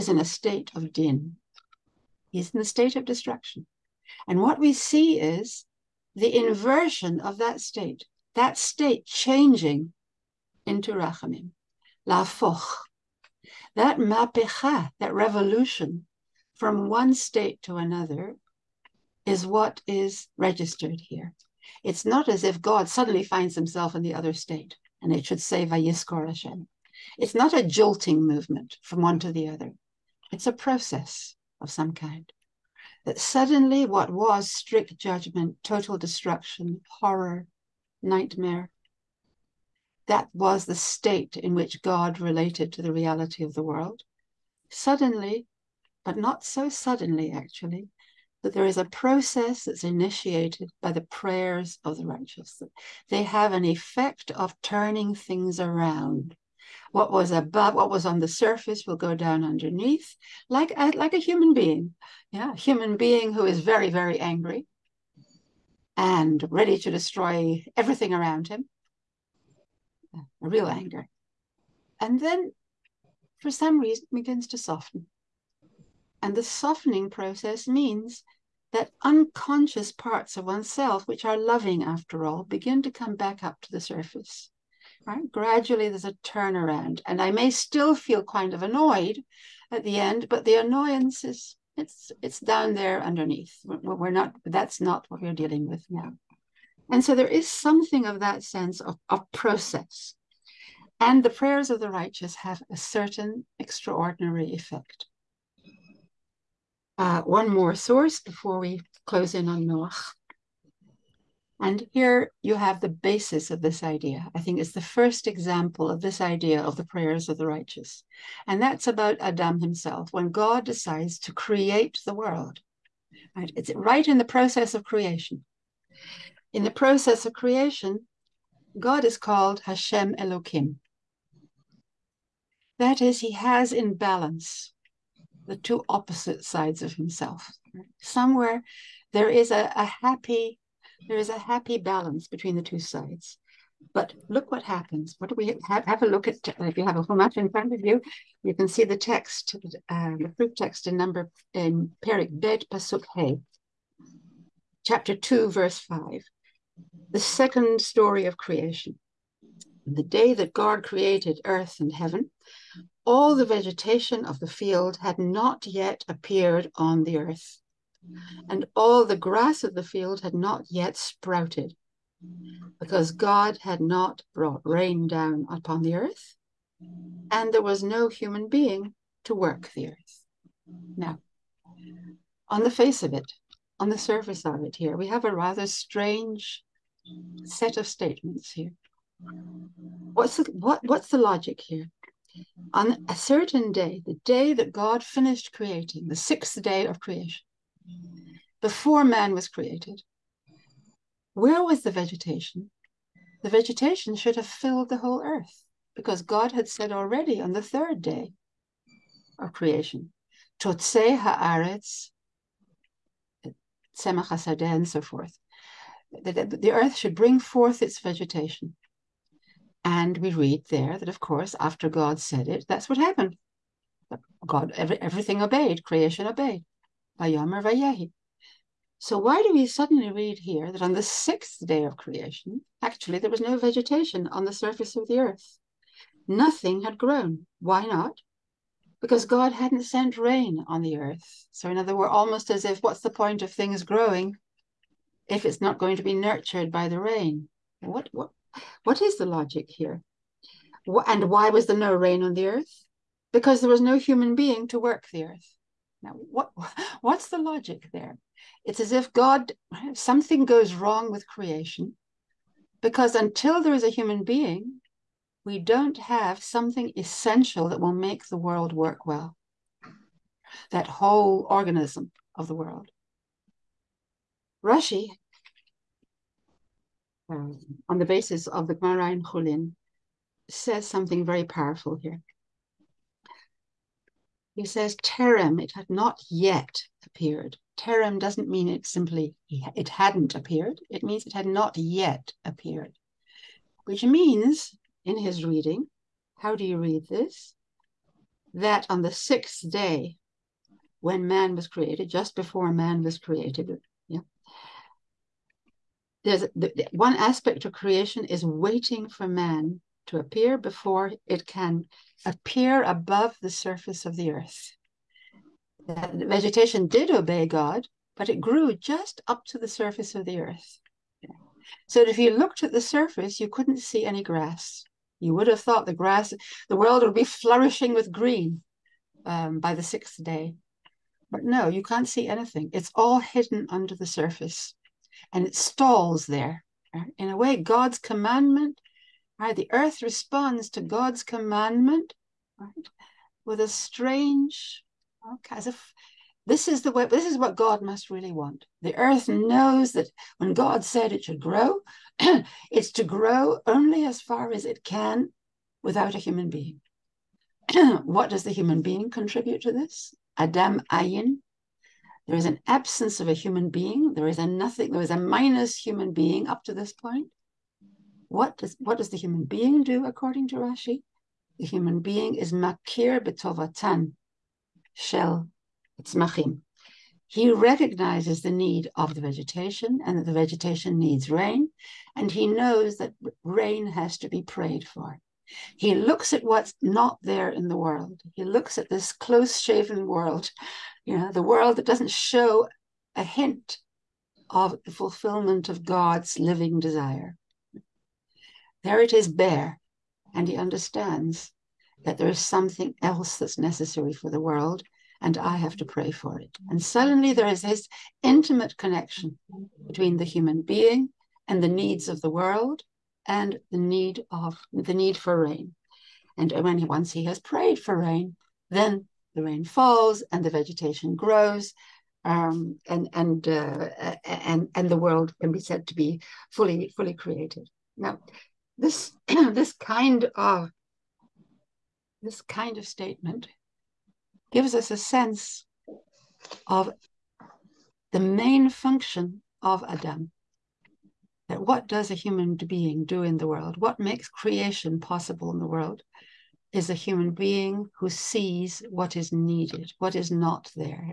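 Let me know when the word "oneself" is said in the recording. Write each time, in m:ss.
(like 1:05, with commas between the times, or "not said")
1:20.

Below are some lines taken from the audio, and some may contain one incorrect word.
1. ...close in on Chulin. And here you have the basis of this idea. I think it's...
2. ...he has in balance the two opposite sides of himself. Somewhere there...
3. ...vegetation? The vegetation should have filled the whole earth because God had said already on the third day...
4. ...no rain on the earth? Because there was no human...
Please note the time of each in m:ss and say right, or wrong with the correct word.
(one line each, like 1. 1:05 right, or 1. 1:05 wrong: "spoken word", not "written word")
1. 1:49 wrong: "Noach", not "Chulin"
2. 2:13 right
3. 3:21 right
4. 4:11 right.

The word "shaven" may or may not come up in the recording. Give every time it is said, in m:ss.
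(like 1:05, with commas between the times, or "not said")
6:29.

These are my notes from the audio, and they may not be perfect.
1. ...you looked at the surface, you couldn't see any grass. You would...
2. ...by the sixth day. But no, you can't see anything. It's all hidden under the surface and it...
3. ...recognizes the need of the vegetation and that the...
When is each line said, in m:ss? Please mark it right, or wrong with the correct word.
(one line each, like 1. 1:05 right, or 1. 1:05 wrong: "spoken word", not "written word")
1. 5:22 right
2. 5:29 right
3. 6:17 right.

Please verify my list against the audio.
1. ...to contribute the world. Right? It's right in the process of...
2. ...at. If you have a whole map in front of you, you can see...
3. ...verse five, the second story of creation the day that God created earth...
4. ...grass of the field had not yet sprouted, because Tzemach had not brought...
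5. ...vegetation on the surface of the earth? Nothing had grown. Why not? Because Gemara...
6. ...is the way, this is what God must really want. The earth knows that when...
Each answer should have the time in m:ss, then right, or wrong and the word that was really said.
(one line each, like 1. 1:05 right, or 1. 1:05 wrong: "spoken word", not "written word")
1. 2:01 wrong: "create", not "contribute"
2. 2:26 right
3. 2:35 right
4. 2:49 wrong: "God", not "Tzemach"
5. 3:53 wrong: "God", not "Gemara"
6. 5:46 right.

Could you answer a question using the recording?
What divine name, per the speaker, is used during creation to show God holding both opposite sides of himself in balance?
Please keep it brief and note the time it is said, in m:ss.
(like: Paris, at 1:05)
Hashem Elohim, at 2:09.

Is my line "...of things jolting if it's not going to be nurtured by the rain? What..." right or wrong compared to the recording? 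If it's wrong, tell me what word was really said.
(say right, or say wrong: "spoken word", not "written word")
wrong: "growing", not "jolting".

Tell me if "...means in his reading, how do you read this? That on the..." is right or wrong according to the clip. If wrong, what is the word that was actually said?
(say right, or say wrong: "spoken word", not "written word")
right.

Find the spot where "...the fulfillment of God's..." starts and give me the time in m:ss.
6:34.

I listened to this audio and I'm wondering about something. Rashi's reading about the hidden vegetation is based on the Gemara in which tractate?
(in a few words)
Chulin.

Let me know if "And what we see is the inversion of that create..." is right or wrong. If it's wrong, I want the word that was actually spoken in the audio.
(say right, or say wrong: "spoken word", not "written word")
wrong: "state", not "create".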